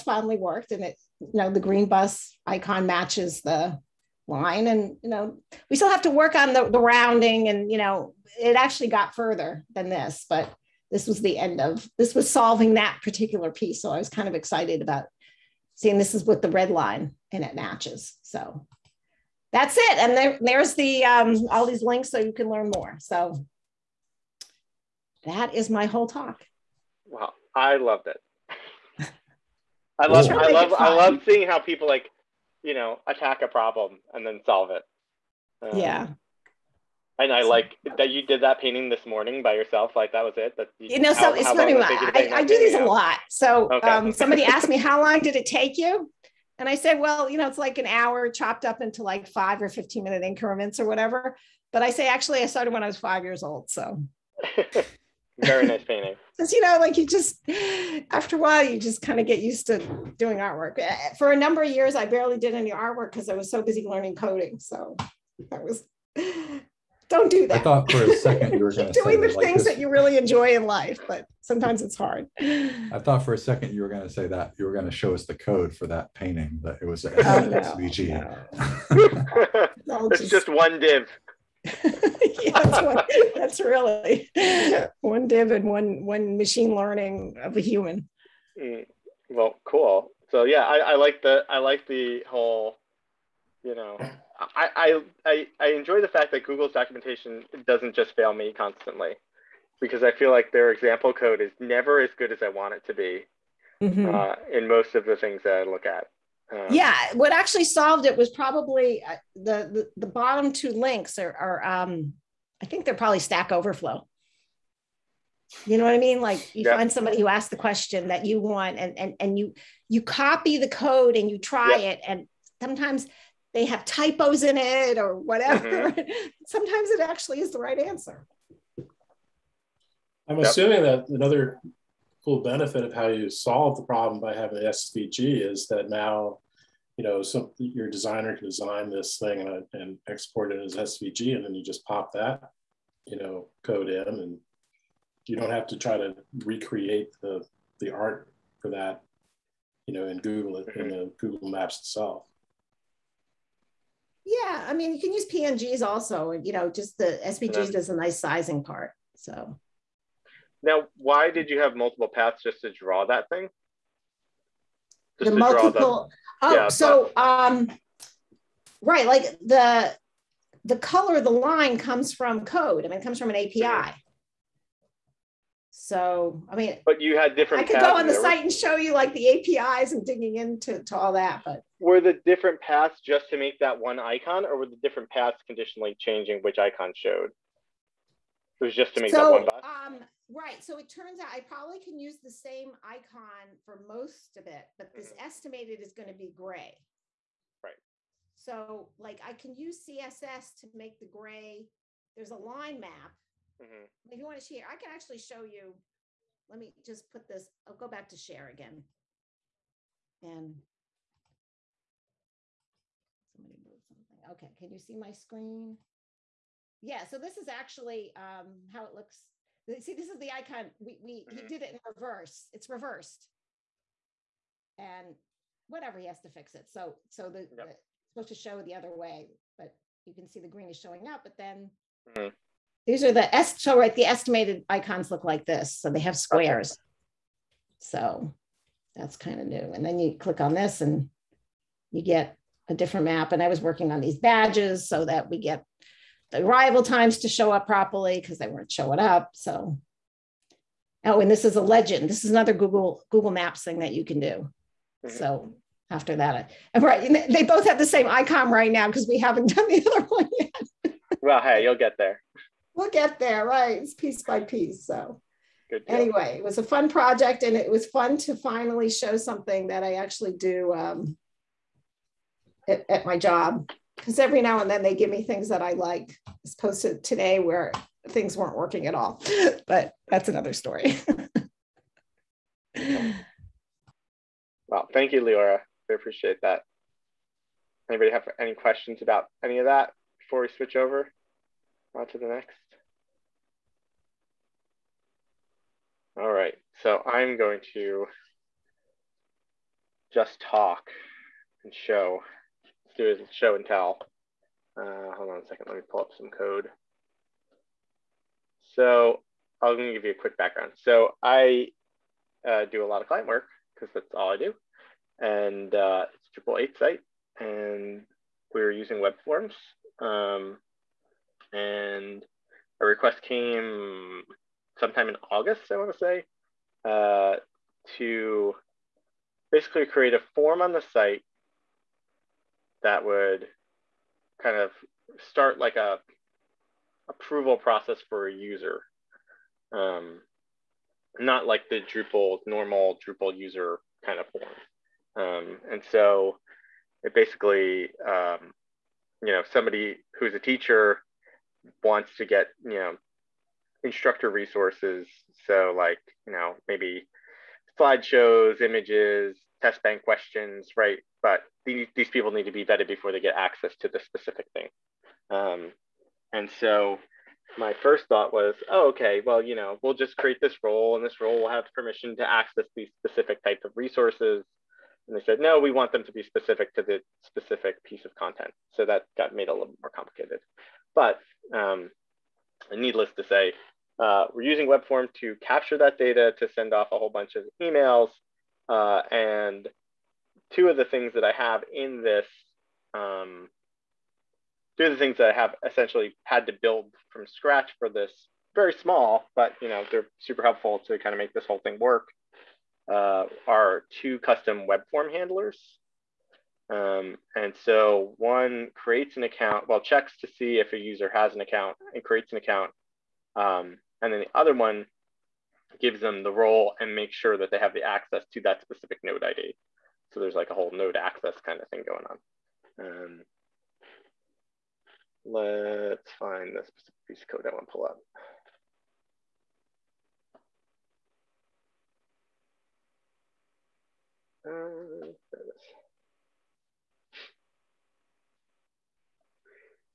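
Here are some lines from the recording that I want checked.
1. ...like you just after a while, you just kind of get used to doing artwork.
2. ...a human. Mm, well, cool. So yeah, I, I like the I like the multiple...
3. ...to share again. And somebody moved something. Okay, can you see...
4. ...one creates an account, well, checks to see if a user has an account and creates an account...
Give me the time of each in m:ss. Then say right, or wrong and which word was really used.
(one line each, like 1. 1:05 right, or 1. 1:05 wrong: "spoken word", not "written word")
1. 0:56 right
2. 1:27 wrong: "whole", not "multiple"
3. 3:28 right
4. 6:48 right.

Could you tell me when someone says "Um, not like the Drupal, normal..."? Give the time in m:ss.
5:39.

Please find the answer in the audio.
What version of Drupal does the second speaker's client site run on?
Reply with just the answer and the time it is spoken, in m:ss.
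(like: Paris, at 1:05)
Drupal 8, at 5:16.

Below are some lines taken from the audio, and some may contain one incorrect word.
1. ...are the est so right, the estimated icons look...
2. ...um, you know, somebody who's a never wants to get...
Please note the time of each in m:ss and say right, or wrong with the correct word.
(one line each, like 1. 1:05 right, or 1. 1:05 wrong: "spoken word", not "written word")
1. 3:53 right
2. 5:48 wrong: "teacher", not "never".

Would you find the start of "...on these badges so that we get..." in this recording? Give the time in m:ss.
4:03.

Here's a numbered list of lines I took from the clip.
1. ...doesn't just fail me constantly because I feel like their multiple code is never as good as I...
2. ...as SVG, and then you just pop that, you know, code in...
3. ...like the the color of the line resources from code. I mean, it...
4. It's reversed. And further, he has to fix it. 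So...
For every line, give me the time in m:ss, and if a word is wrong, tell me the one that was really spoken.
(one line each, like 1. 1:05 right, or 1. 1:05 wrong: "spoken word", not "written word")
1. 1:37 wrong: "example", not "multiple"
2. 2:20 right
3. 2:49 wrong: "comes", not "resources"
4. 3:42 wrong: "whatever", not "further".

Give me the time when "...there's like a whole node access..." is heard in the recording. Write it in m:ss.
7:00.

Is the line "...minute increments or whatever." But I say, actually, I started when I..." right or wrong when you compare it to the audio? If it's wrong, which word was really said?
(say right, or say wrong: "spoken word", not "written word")
right.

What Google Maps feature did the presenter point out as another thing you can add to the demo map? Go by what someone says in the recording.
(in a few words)
legend.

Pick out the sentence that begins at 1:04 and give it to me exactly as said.
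So that was don't do that.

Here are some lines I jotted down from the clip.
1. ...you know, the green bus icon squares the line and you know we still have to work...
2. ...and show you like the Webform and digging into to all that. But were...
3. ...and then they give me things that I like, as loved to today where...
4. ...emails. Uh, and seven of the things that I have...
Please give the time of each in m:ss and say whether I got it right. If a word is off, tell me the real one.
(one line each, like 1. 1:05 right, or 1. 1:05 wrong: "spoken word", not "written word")
1. 0:01 wrong: "matches", not "squares"
2. 2:58 wrong: "APIs", not "Webform"
3. 4:34 wrong: "opposed", not "loved"
4. 6:27 wrong: "two", not "seven".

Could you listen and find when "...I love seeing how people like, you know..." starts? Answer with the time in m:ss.
0:30.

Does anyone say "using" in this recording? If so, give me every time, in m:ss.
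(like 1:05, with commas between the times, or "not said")
5:18, 6:24.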